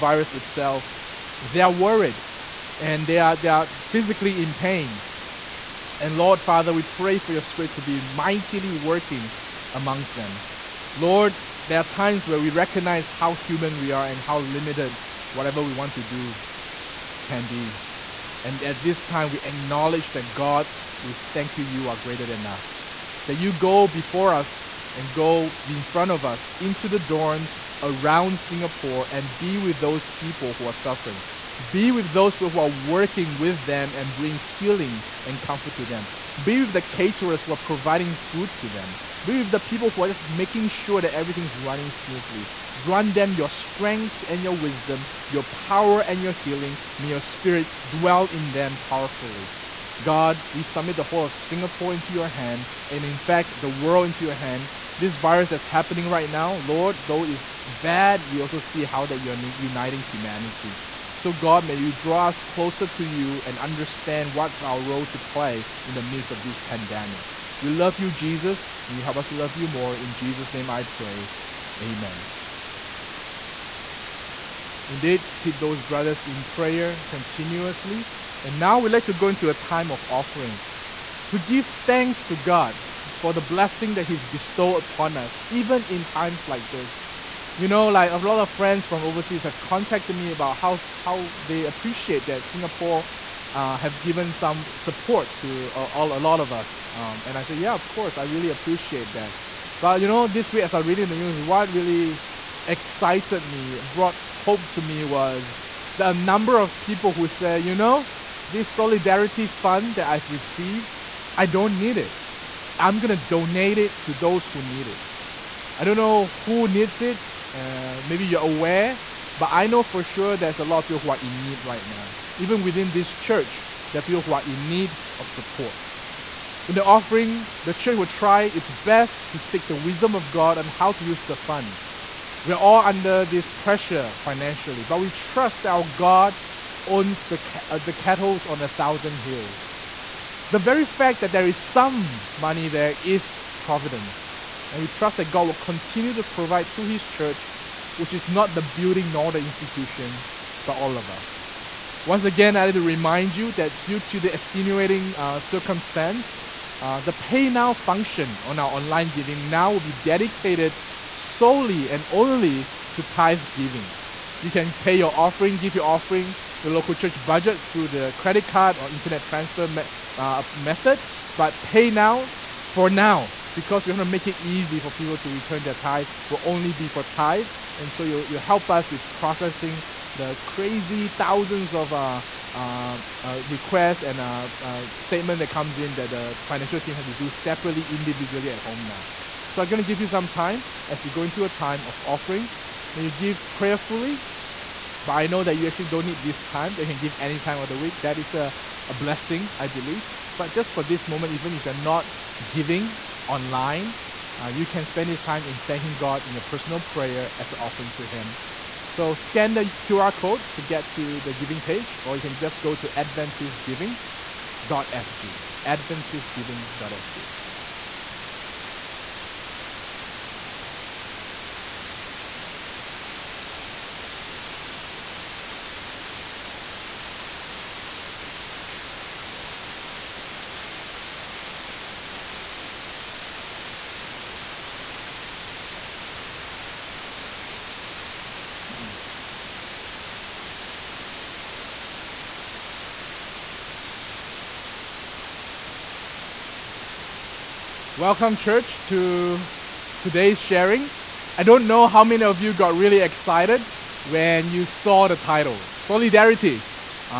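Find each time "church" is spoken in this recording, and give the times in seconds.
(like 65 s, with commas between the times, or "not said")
123 s, 127 s, 147 s, 166 s, 248 s.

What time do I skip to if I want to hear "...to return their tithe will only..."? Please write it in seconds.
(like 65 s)
175 s.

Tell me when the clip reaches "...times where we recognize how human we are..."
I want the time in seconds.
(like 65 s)
11 s.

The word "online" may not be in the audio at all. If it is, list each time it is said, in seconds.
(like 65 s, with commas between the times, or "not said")
158 s, 203 s.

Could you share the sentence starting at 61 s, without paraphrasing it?
So, God, may you draw us closer to you and understand what's our role to play in the midst of this pandemic.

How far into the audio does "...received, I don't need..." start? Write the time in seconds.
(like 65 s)
110 s.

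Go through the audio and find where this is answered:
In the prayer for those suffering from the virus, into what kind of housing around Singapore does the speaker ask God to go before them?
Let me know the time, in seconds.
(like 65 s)
26 s.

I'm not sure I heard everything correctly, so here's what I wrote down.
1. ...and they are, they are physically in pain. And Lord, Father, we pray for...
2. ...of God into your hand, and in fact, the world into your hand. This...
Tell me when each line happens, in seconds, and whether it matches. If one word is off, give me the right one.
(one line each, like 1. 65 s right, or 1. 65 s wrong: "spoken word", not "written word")
1. 2 s right
2. 51 s wrong: "Singapore", not "God".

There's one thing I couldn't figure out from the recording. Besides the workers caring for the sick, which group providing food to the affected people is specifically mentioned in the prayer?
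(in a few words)
caterers.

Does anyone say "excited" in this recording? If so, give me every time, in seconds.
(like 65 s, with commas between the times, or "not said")
102 s, 252 s.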